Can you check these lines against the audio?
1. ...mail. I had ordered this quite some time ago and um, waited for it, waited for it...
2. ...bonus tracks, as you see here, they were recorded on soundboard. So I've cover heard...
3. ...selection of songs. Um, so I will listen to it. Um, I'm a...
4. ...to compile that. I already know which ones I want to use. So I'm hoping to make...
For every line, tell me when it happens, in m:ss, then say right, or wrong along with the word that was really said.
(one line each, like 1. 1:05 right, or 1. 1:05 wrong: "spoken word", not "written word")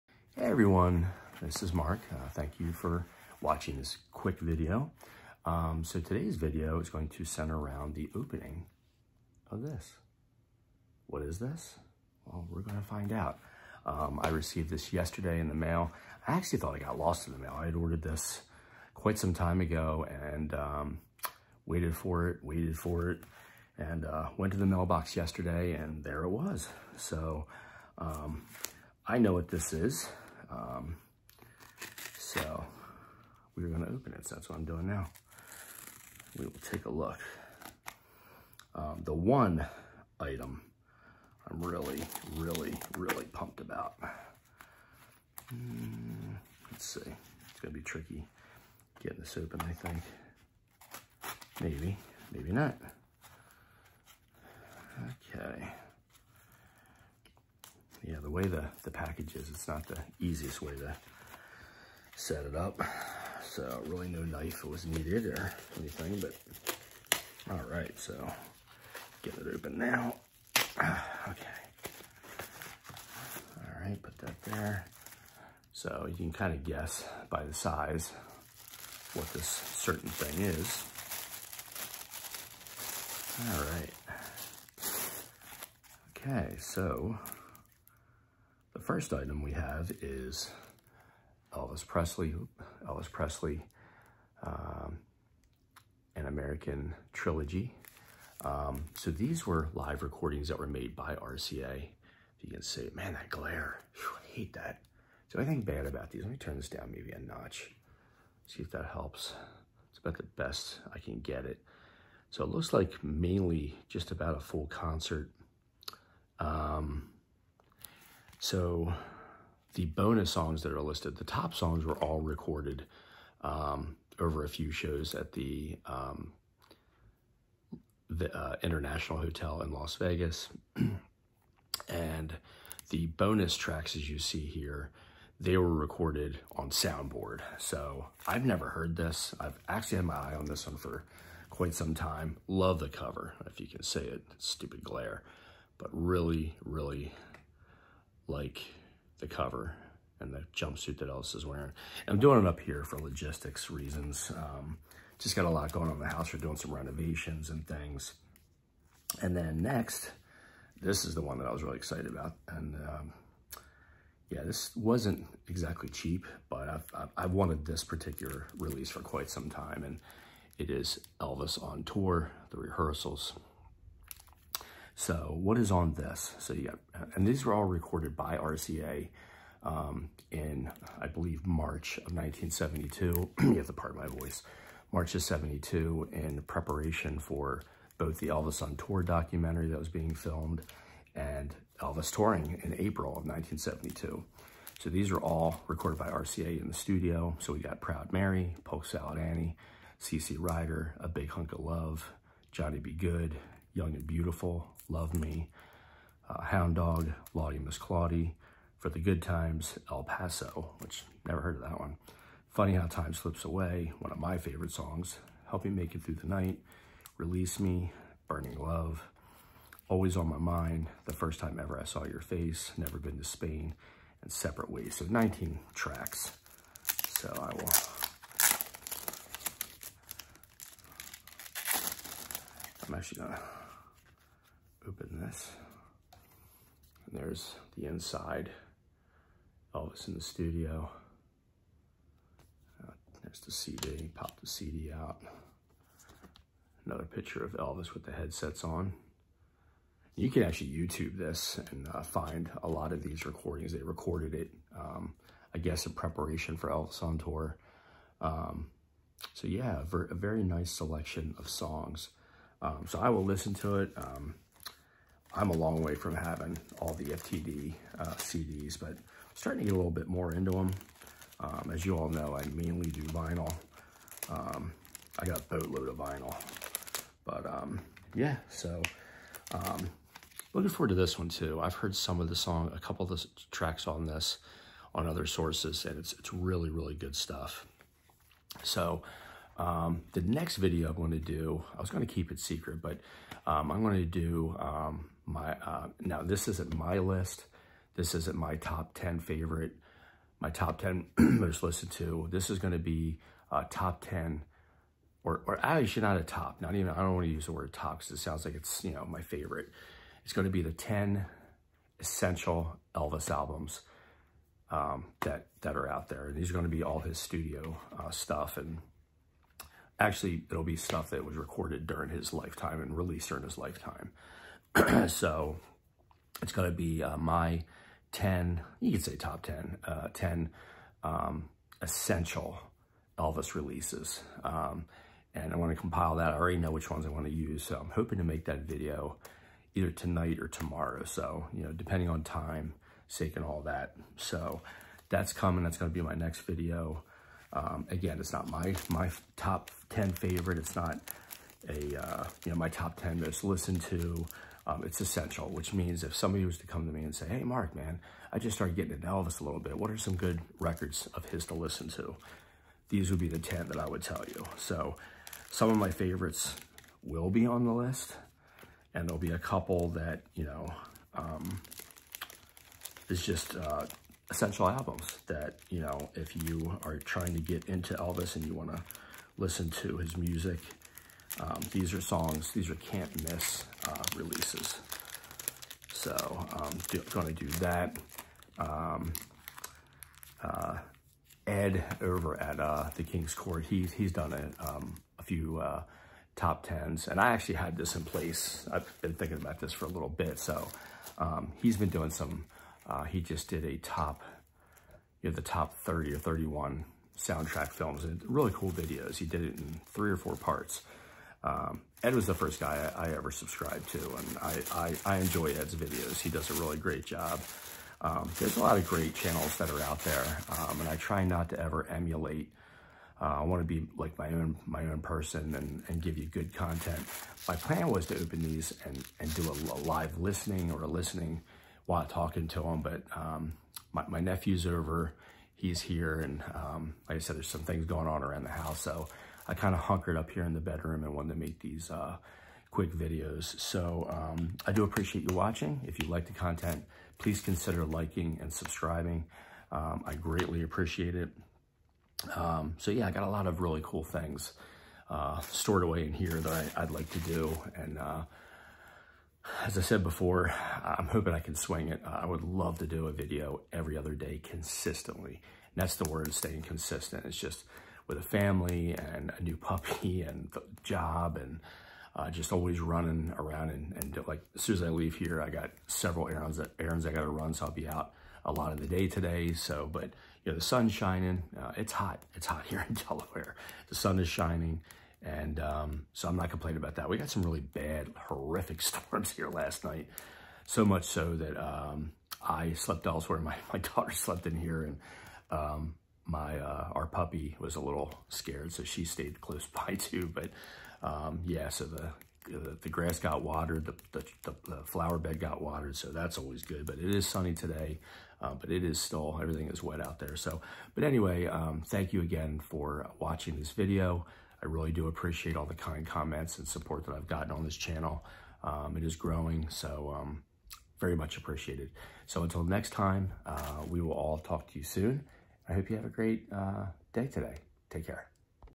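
1. 0:17 right
2. 2:13 wrong: "never", not "cover"
3. 4:20 right
4. 5:35 right.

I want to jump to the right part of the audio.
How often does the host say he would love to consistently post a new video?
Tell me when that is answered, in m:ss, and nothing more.
7:43.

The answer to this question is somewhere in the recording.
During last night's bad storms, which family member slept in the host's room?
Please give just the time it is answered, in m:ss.
8:13.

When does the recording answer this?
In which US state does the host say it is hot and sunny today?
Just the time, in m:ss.
8:02.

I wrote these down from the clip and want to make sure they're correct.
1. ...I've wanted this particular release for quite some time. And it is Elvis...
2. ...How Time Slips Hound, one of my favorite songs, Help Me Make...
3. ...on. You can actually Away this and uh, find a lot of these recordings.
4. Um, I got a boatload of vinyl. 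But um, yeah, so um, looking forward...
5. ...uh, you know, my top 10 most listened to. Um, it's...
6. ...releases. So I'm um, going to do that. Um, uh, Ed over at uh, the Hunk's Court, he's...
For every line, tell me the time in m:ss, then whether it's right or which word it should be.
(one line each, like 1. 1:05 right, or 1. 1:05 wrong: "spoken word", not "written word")
1. 2:47 right
2. 3:32 wrong: "Away", not "Hound"
3. 4:08 wrong: "YouTube", not "Away"
4. 4:34 right
5. 5:52 right
6. 6:24 wrong: "King", not "Hunk".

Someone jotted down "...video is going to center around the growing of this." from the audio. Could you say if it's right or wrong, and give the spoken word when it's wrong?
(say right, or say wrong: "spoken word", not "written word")
wrong: "opening", not "growing".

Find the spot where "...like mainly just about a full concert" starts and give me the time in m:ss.
1:52.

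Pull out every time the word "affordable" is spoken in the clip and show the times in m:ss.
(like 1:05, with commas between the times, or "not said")
not said.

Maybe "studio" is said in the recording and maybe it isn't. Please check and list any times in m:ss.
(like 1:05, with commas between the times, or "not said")
3:16, 4:00, 5:17.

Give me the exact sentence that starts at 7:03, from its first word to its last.
Uh, I want to be like my own my own person and, and give you good content.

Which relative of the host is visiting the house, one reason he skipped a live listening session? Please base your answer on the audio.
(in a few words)
nephew.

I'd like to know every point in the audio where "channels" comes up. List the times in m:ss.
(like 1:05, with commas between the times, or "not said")
6:59, 8:37.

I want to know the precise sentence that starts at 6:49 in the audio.
He did it in three or four parts.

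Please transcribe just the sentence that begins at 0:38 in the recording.
Um, the one item I'm really, really, really pumped about.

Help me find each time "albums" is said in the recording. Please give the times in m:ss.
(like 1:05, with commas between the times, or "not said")
5:13, 6:14.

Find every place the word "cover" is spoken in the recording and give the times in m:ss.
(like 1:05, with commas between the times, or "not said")
2:22, 2:29.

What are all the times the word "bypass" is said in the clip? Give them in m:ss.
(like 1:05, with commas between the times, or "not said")
not said.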